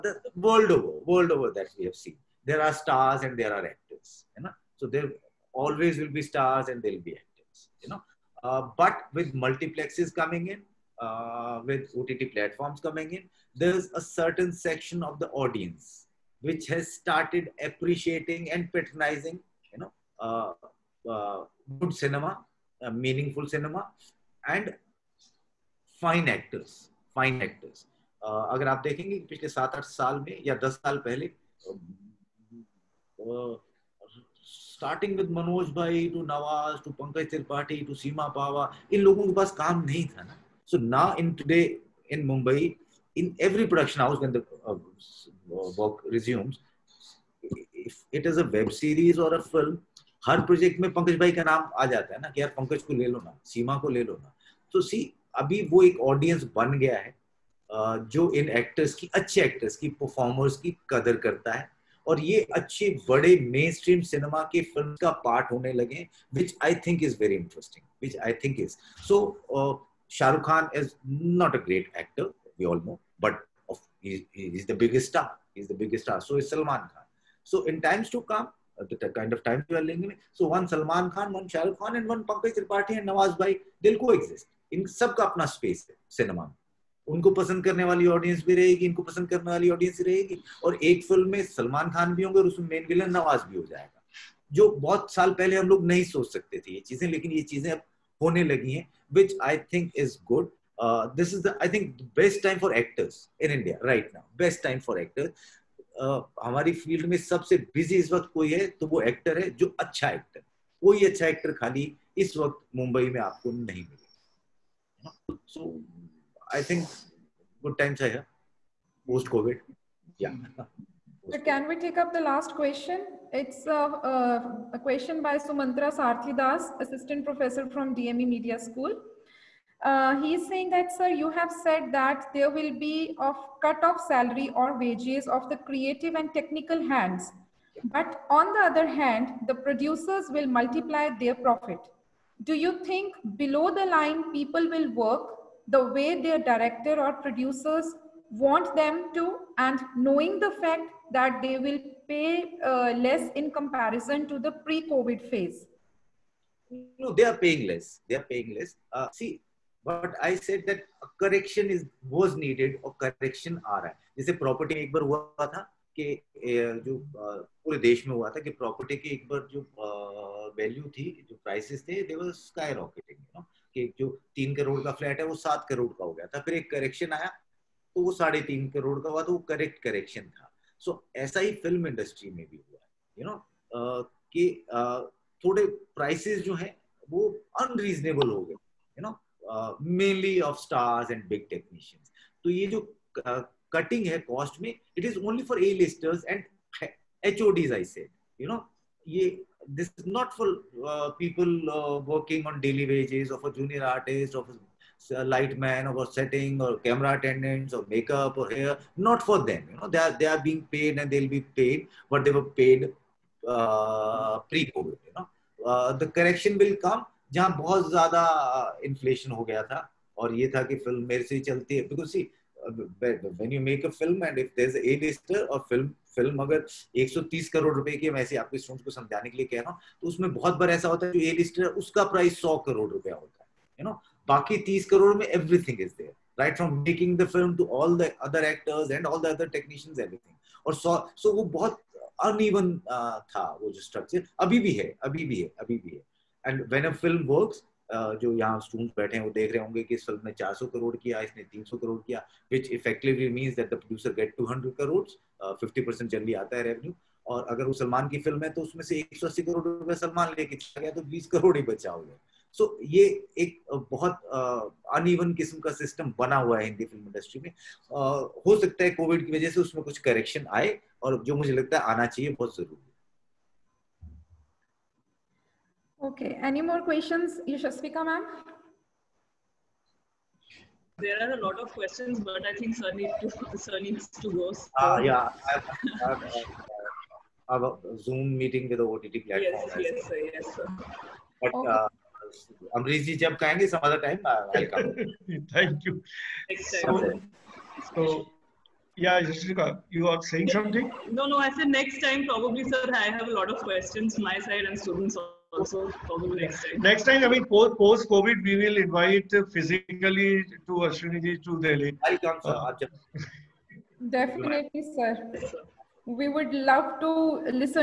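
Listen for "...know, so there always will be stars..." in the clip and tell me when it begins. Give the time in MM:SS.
00:04.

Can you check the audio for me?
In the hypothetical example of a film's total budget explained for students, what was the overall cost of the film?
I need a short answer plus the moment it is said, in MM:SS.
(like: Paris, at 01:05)
130 crore, at 03:47.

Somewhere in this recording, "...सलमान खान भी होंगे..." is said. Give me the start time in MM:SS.
01:31.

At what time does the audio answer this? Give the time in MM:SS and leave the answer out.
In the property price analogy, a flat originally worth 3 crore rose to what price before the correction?
02:55.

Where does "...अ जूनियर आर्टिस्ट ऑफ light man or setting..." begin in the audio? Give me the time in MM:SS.
03:23.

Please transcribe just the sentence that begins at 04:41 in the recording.
There are a lot of questions, but I think sir needs to, sir needs to go.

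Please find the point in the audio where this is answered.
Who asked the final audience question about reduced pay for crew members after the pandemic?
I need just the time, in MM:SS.
02:05.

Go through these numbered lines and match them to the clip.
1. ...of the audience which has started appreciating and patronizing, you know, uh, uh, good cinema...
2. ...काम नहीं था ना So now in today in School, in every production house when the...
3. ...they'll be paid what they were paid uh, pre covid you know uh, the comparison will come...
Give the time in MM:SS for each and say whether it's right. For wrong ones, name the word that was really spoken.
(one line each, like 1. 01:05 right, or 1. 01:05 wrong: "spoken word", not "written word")
1. 00:15 right
2. 00:39 wrong: "Mumbai", not "School"
3. 03:31 wrong: "correction", not "comparison".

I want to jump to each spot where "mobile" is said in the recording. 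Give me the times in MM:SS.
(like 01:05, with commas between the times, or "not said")
not said.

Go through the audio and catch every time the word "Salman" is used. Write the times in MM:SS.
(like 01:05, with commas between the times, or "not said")
01:16, 01:20.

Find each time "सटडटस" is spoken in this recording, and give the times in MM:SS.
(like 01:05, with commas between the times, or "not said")
03:48, 04:08.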